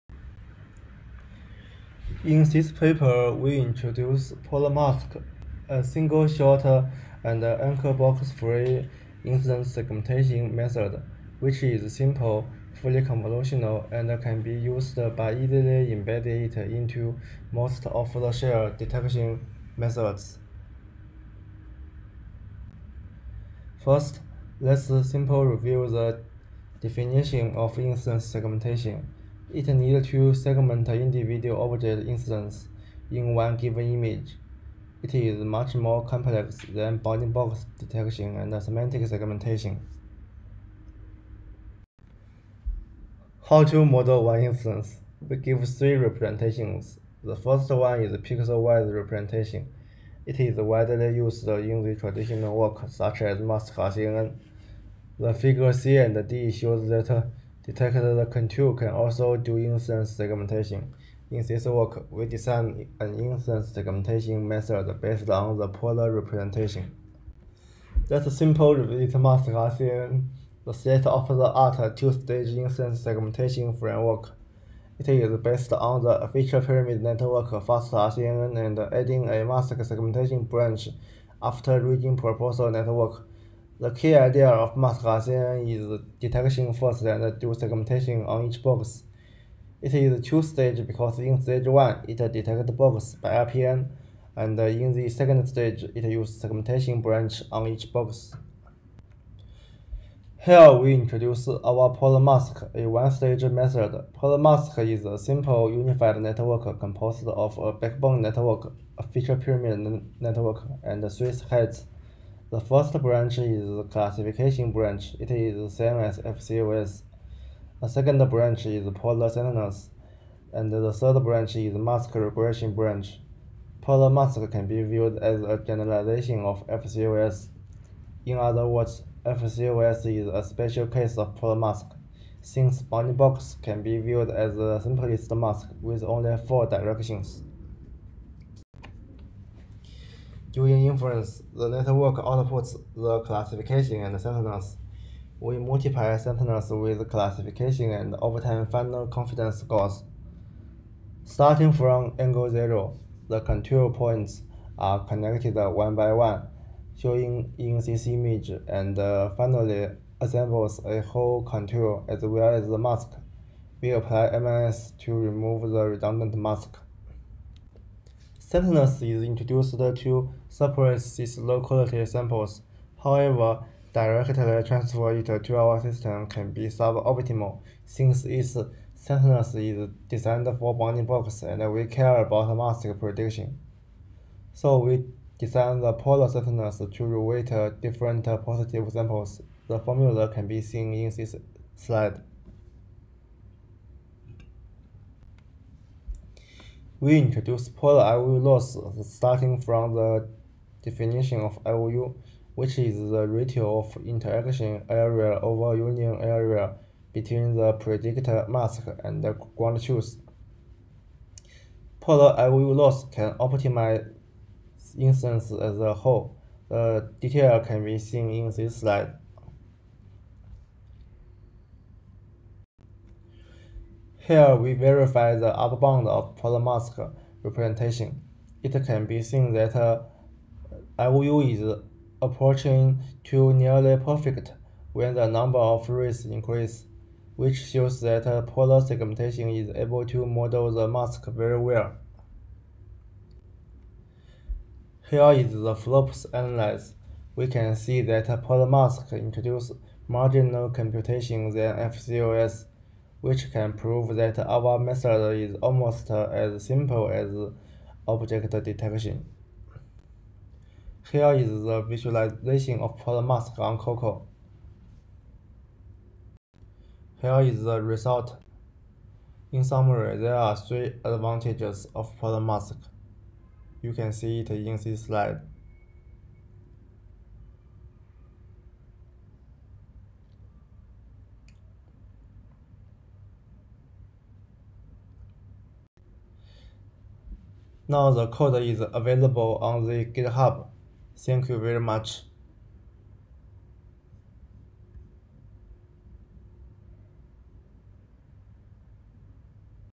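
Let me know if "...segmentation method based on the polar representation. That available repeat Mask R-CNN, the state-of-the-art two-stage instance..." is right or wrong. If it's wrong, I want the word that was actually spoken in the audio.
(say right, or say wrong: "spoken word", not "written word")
wrong: "simple", not "available".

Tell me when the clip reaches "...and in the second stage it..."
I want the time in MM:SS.
01:34.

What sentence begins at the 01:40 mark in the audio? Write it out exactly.
Here we introduce our polar mask, a one-stage method.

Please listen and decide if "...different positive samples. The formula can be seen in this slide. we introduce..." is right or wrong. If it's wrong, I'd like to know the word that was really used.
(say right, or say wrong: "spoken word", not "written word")
right.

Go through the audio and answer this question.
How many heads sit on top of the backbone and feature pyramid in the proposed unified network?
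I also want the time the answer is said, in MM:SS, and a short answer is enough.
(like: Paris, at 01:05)
3, at 01:51.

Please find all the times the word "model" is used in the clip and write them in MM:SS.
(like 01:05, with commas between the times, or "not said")
00:43, 04:00.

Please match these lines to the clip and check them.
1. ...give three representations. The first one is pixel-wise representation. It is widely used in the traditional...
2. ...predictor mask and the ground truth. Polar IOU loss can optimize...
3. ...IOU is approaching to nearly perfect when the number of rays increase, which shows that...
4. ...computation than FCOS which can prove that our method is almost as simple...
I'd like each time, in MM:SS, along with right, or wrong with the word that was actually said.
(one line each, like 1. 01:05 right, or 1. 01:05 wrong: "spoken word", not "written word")
1. 00:45 right
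2. 03:27 right
3. 03:50 right
4. 04:10 right.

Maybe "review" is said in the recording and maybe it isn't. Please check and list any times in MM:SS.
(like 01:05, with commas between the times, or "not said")
00:25.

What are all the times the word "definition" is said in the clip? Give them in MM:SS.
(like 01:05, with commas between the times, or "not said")
00:26, 03:20.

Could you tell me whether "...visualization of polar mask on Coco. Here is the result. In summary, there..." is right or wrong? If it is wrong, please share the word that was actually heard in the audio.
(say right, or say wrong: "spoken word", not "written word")
right.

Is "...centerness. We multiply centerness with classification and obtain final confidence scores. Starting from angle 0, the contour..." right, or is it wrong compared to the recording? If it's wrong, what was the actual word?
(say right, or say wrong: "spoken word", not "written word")
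right.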